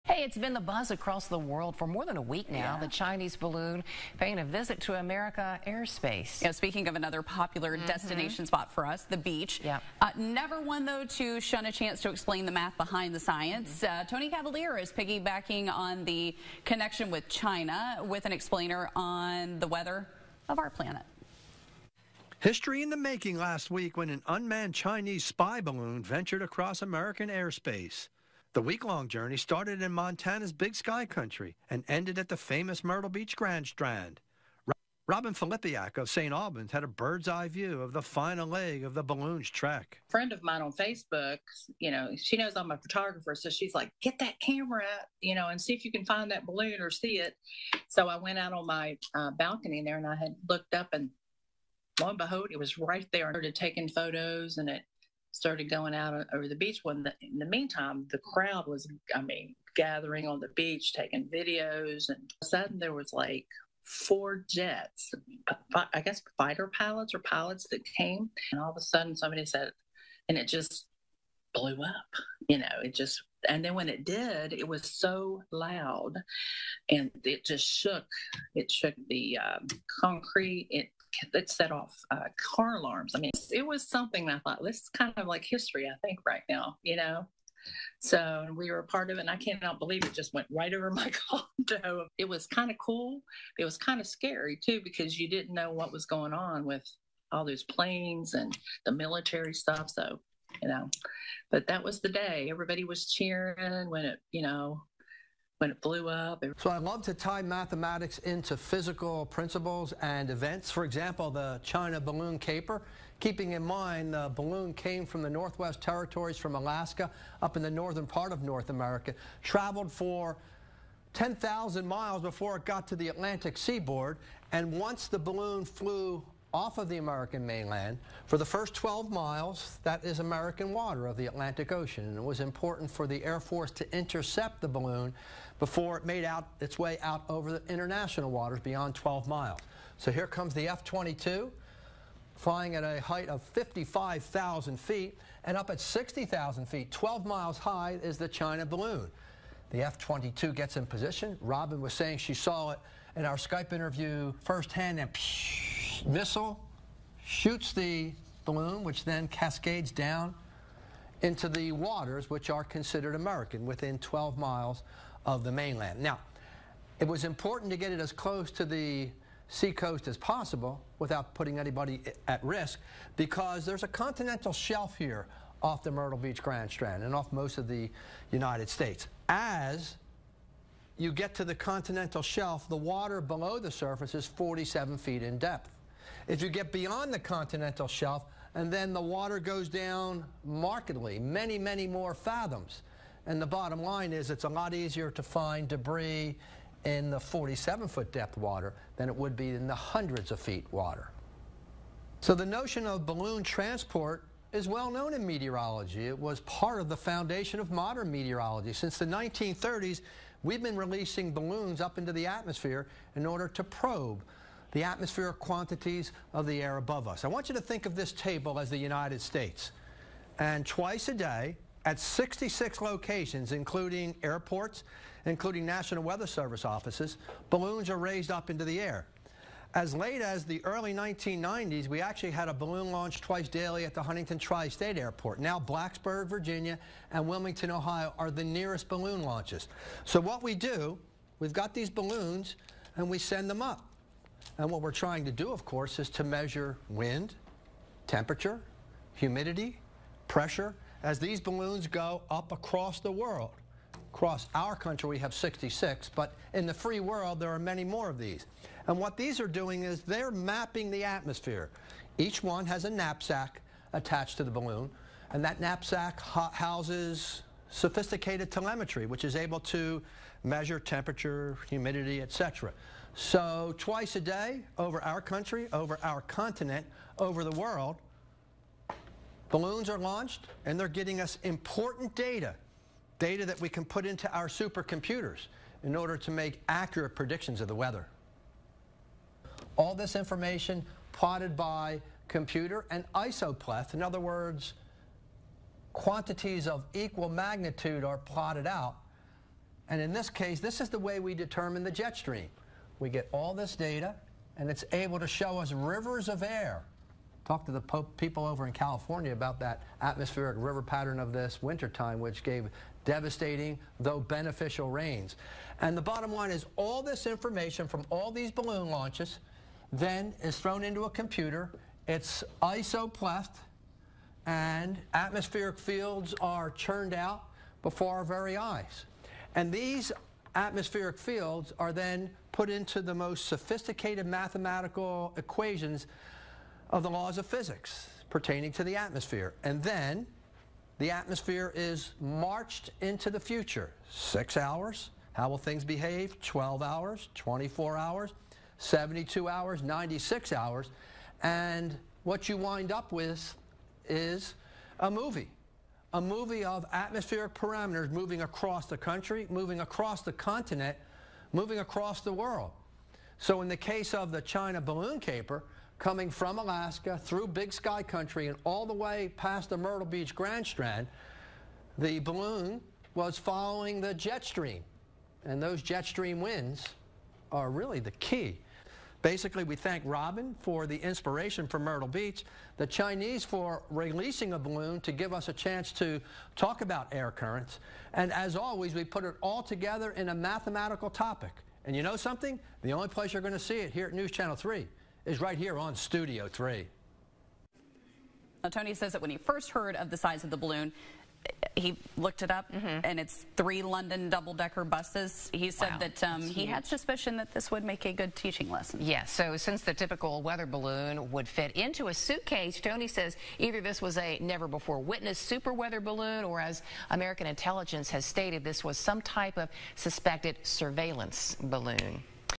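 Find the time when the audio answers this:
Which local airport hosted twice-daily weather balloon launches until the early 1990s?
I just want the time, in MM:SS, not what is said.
03:54.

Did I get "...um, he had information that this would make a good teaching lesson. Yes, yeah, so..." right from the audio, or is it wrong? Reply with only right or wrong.
wrong.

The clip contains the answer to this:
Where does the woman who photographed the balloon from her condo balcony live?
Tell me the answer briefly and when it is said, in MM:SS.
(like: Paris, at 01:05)
St. Albans, at 00:36.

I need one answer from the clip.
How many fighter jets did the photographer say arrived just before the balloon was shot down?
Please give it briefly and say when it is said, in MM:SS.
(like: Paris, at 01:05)
4, at 01:03.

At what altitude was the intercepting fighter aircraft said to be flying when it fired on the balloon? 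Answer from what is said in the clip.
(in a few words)
55,000 feet.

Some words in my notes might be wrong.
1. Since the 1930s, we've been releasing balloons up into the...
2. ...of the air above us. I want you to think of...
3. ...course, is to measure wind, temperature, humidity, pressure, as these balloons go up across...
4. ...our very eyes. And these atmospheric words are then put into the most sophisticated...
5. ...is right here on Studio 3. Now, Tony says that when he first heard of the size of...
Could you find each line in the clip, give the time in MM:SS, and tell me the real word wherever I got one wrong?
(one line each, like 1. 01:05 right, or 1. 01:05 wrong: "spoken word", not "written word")
1. 03:28 right
2. 03:36 right
3. 04:05 right
4. 05:28 wrong: "fields", not "words"
5. 06:35 right.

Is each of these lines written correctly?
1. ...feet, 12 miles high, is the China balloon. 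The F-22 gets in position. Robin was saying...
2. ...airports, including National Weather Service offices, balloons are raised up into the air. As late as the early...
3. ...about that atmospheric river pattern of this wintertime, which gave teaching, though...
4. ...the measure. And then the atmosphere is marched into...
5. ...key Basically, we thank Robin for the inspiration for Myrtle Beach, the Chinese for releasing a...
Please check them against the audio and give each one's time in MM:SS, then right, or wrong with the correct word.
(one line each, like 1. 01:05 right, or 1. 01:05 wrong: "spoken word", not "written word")
1. 02:26 right
2. 03:44 right
3. 05:09 wrong: "devastating", not "teaching"
4. 05:38 wrong: "atmosphere", not "measure"
5. 06:18 right.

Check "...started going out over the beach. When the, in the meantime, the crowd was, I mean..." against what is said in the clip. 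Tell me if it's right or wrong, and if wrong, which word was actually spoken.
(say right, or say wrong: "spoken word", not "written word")
right.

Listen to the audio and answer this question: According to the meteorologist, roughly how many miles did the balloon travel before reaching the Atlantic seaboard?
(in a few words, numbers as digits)
10,000 miles.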